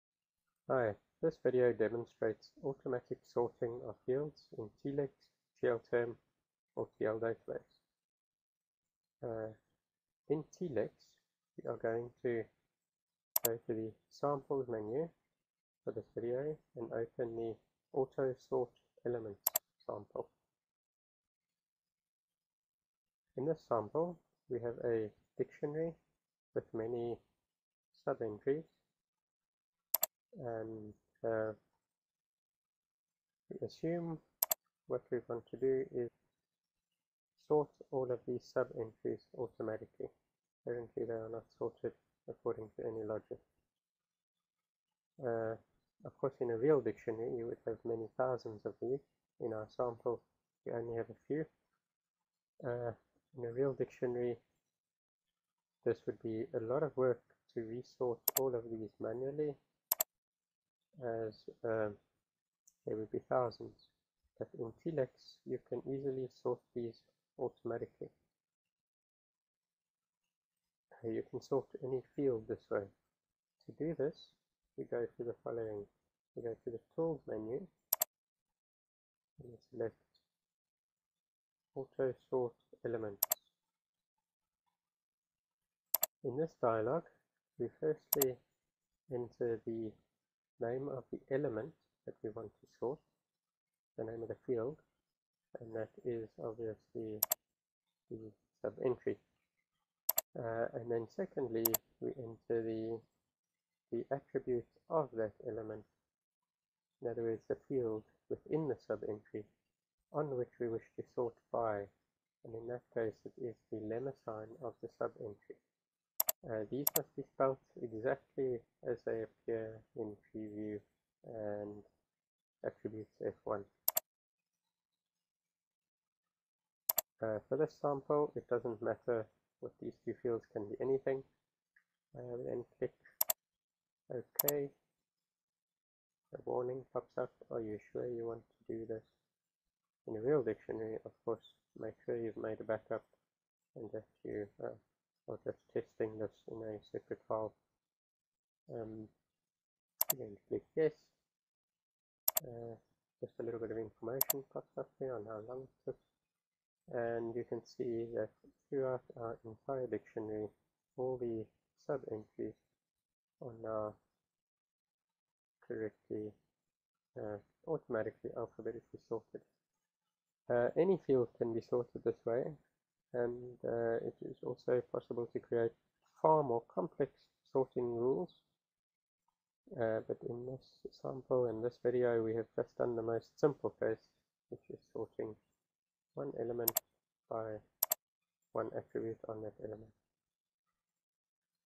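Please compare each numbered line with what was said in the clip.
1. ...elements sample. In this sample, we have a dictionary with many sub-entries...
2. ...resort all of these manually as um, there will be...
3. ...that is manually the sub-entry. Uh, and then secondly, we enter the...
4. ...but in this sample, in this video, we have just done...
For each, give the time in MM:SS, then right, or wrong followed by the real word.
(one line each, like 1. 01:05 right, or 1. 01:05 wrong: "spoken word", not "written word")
1. 00:19 right
2. 00:57 right
3. 01:35 wrong: "obviously", not "manually"
4. 03:00 right.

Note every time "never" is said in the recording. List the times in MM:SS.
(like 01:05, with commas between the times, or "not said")
not said.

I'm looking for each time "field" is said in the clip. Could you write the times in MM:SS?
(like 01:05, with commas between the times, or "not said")
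00:04, 01:12, 01:34, 01:47, 02:10, 02:51.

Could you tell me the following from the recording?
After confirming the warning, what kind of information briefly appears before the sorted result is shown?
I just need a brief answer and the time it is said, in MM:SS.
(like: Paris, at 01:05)
Language groups, at 02:35.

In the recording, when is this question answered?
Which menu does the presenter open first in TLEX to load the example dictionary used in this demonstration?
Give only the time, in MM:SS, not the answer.
00:14.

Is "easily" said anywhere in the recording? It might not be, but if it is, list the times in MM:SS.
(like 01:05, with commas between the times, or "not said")
01:05.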